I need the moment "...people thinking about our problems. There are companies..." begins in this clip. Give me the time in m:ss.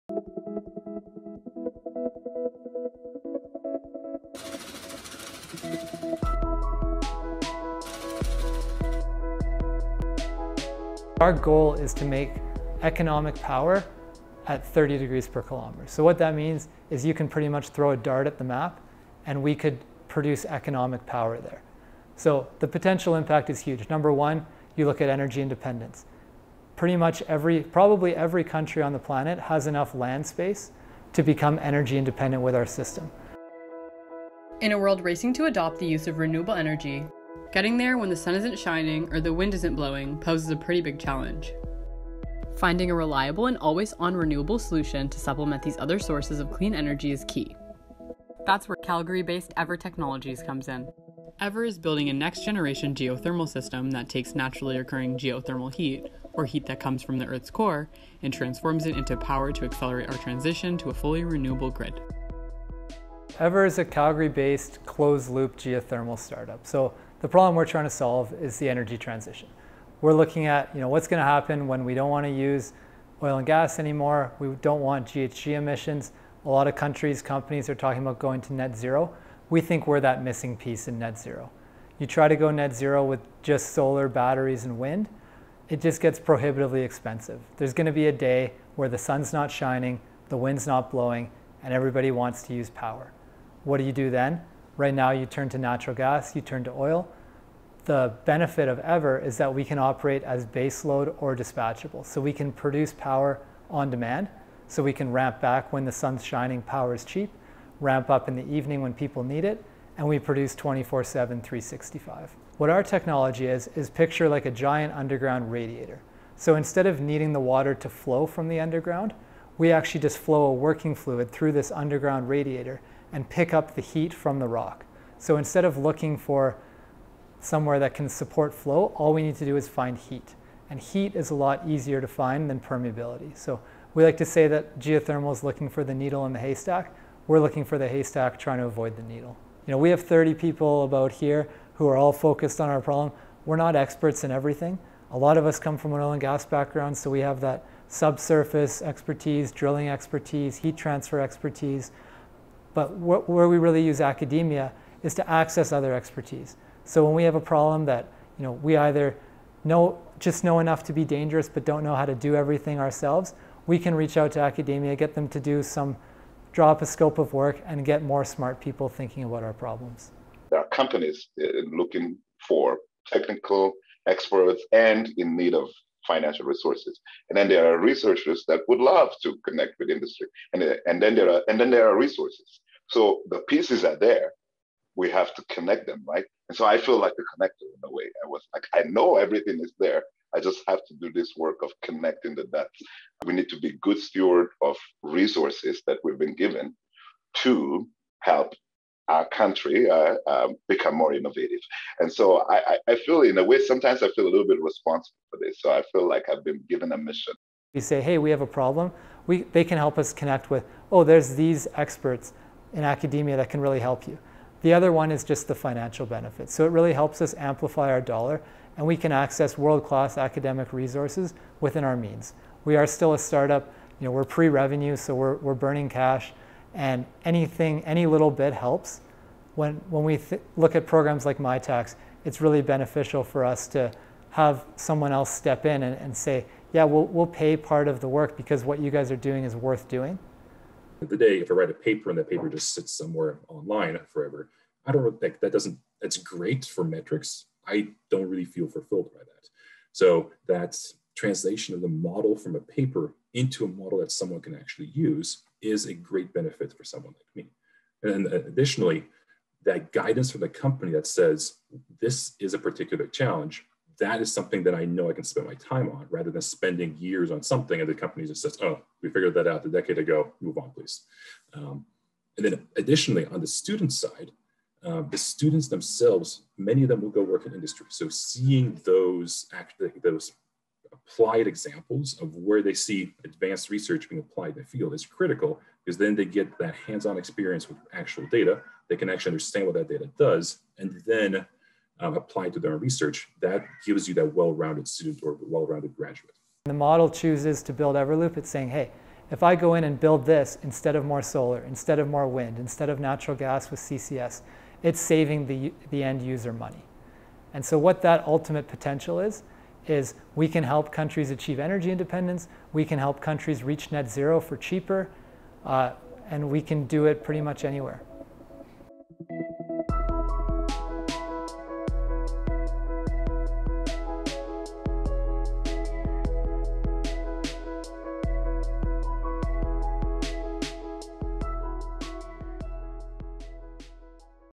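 2:48.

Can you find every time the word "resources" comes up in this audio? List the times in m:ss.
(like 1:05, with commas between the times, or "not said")
2:56, 3:01, 3:15, 3:40.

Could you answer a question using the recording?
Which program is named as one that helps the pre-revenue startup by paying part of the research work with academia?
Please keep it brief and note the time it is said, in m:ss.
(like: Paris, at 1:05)
Mitacs, at 3:51.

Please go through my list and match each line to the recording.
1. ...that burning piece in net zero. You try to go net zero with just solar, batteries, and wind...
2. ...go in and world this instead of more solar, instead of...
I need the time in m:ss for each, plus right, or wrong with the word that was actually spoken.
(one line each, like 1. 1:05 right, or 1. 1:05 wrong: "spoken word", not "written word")
1. 1:19 wrong: "missing", not "burning"
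2. 4:59 wrong: "build", not "world".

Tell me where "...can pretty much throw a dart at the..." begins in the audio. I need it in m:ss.
0:17.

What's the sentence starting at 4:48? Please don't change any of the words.
They can actually understand what that data does and then um, apply to their own research.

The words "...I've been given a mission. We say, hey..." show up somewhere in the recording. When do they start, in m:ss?
3:26.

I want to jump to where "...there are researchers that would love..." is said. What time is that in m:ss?
2:57.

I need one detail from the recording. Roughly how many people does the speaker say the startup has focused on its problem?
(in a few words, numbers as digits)
30.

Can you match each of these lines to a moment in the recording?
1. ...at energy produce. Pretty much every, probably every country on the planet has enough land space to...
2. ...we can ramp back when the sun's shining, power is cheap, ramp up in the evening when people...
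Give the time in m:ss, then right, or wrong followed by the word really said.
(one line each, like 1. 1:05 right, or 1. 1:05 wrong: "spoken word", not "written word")
1. 0:24 wrong: "independence", not "produce"
2. 1:44 right.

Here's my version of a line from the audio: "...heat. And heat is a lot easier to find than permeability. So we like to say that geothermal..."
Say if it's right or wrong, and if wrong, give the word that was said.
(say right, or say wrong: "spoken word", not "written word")
right.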